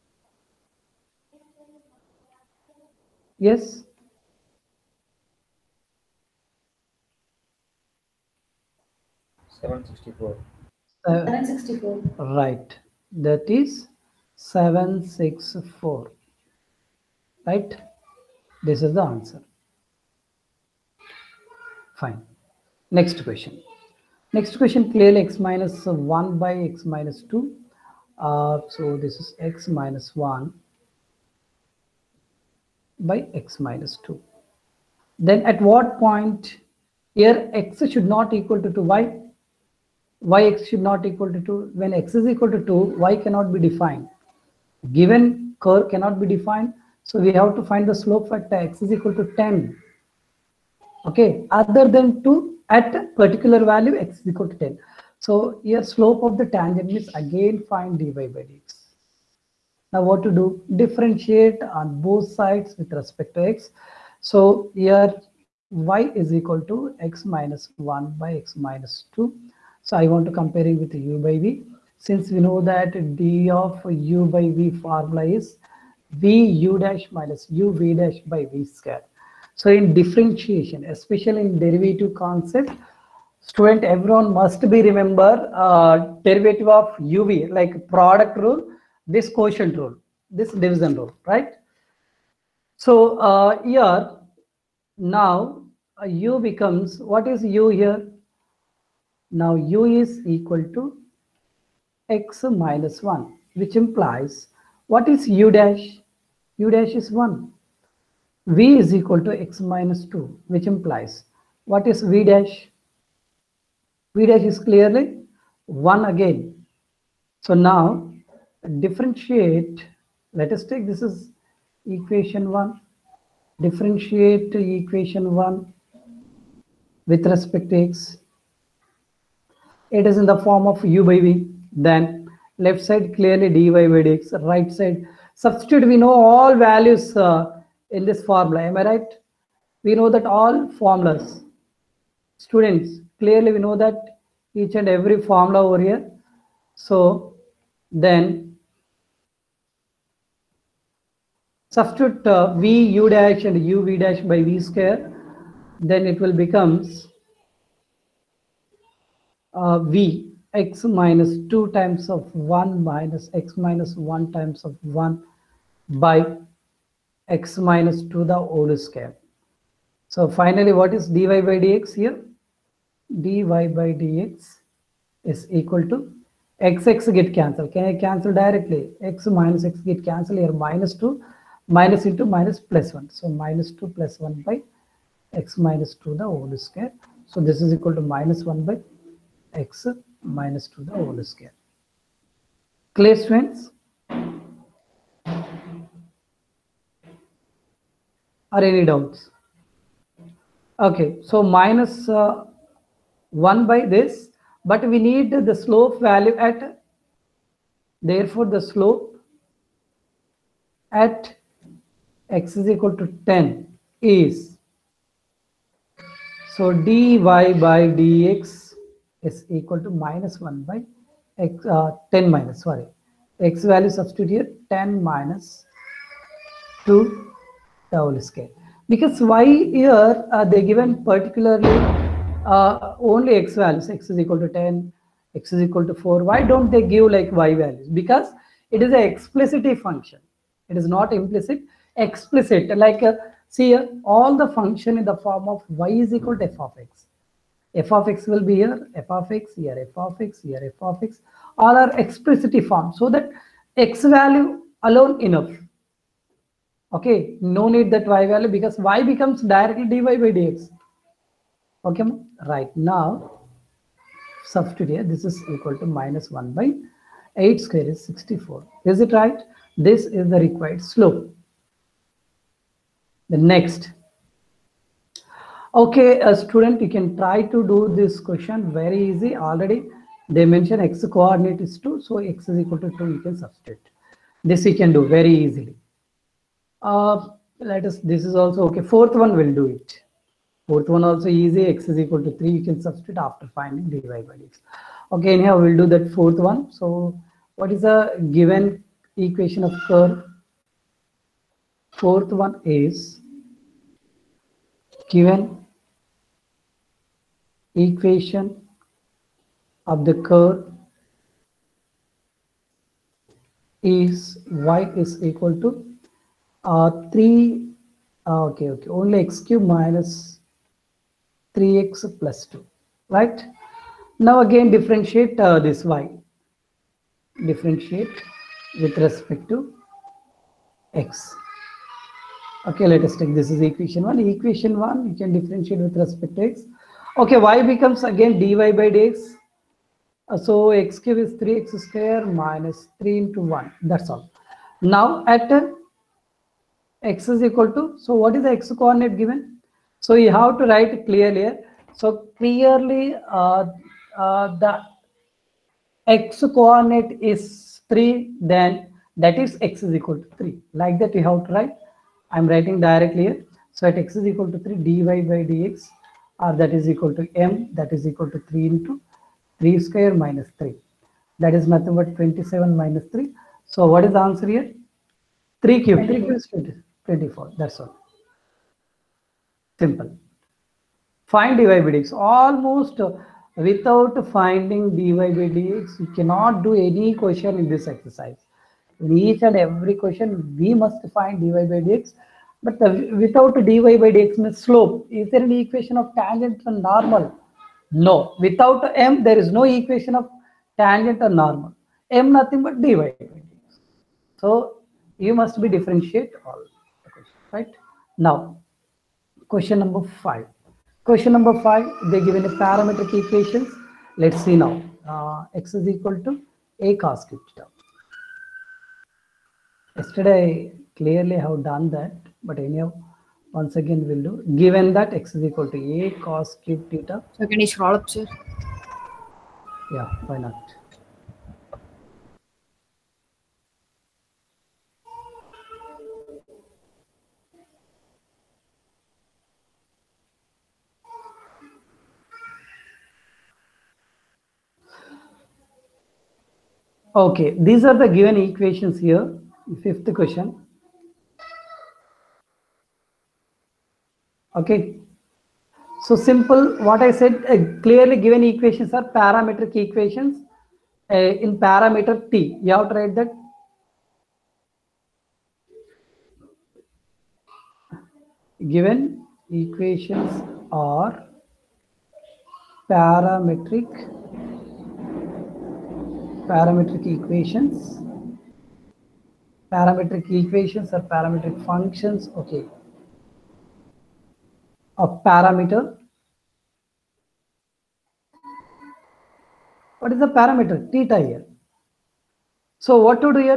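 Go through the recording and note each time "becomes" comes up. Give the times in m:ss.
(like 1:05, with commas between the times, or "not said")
1:36, 2:36, 4:19, 5:37.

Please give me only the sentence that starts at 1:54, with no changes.
v dash is clearly 1 again.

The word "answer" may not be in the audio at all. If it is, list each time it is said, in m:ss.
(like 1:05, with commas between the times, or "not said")
0:19, 6:14.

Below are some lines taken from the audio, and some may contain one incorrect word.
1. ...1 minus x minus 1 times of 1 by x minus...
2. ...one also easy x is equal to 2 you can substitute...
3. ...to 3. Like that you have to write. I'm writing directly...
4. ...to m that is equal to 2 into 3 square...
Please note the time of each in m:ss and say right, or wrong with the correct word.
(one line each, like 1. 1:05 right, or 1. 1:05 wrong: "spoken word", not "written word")
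1. 2:42 right
2. 4:50 wrong: "3", not "2"
3. 6:00 right
4. 6:07 wrong: "3", not "2".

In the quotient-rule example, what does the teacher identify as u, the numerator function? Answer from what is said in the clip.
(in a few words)
x - 1.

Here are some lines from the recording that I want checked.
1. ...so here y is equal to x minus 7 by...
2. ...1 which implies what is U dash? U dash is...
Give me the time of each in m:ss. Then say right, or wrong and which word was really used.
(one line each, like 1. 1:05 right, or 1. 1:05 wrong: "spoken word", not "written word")
1. 1:04 wrong: "1", not "7"
2. 1:43 right.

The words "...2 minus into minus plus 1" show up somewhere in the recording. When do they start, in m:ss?
3:00.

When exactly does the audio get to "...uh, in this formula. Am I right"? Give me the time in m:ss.
2:17.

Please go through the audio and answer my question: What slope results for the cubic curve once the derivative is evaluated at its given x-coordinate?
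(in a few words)
24.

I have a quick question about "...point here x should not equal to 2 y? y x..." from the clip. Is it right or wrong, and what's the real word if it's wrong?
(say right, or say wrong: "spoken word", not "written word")
right.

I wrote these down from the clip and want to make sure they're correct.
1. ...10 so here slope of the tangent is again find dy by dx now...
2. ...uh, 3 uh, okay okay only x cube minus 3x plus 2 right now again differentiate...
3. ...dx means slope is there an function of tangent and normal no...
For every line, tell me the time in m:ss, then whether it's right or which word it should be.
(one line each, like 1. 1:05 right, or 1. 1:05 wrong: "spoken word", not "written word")
1. 0:54 right
2. 5:16 right
3. 6:34 wrong: "equation", not "function".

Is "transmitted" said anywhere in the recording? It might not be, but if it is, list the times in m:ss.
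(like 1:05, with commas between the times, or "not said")
not said.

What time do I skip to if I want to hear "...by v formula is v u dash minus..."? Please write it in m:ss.
1:14.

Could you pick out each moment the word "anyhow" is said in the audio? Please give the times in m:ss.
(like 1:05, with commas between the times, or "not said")
4:55, 7:02.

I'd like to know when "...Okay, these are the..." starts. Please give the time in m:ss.
7:27.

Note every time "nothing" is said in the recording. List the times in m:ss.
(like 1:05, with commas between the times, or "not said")
6:11, 6:42.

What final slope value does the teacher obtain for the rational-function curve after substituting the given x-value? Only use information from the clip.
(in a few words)
-1/64.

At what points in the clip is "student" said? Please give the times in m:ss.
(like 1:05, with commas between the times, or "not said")
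1:23, 2:22, 4:36.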